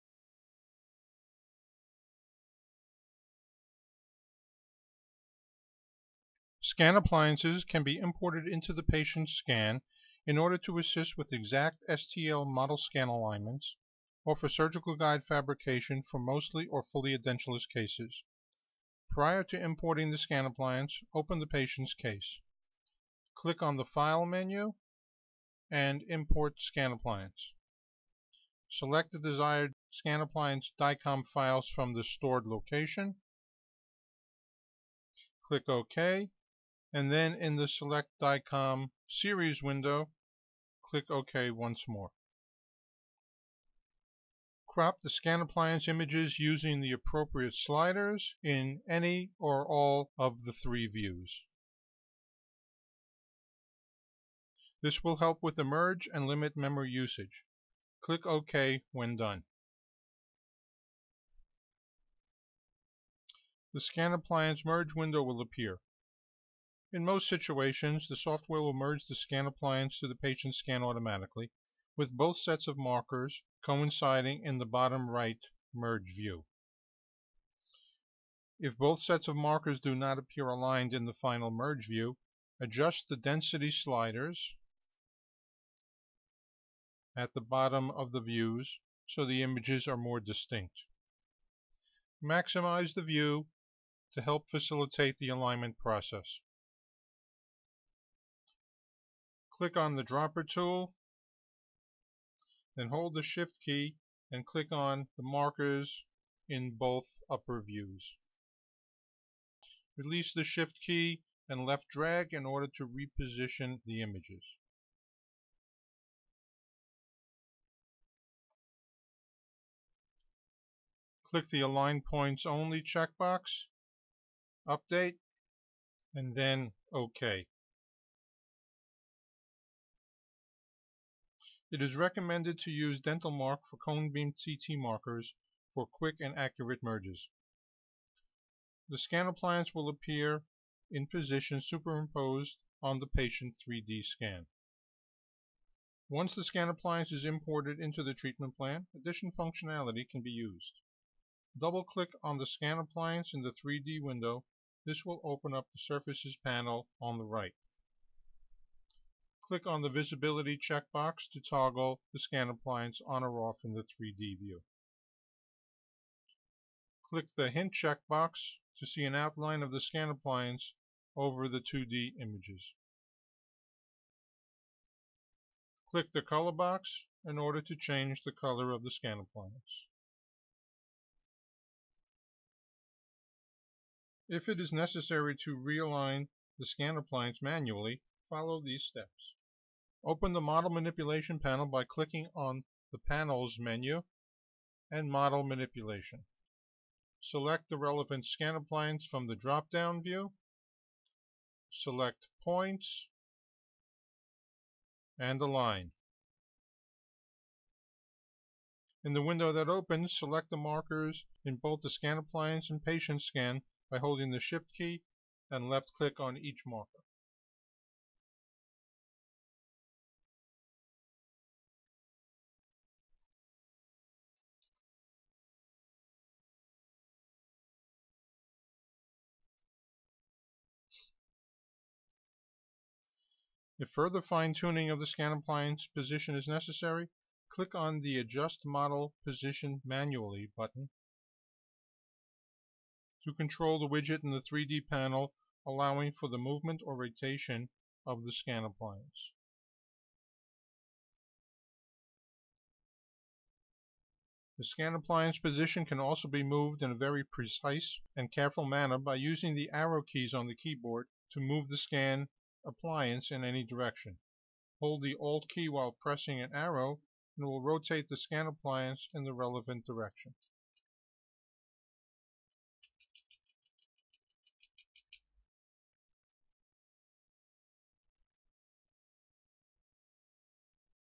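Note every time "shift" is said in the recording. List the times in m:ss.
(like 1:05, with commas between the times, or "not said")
1:43, 1:50, 3:34.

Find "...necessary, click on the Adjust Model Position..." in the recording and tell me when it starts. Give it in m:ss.
3:56.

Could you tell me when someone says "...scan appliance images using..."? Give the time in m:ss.
0:45.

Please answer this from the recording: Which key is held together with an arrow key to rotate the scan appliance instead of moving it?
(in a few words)
Alt.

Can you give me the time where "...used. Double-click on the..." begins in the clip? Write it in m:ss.
2:30.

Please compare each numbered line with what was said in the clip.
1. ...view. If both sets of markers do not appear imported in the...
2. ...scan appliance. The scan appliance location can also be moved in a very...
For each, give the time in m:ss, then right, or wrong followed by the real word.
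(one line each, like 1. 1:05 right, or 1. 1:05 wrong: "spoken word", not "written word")
1. 1:16 wrong: "aligned", not "imported"
2. 4:08 wrong: "position", not "location".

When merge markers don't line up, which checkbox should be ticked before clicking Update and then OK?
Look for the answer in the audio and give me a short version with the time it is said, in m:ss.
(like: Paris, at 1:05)
Align Points Only, at 2:01.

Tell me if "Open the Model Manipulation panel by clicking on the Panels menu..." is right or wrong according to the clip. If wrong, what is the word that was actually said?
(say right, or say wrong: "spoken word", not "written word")
right.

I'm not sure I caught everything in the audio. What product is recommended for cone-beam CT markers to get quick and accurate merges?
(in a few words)
DentalMark.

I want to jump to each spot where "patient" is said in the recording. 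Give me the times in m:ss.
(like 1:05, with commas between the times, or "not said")
0:08, 0:21, 1:10, 2:23, 3:32.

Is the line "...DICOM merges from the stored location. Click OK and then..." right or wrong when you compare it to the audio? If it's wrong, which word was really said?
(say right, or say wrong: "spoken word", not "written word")
wrong: "files", not "merges".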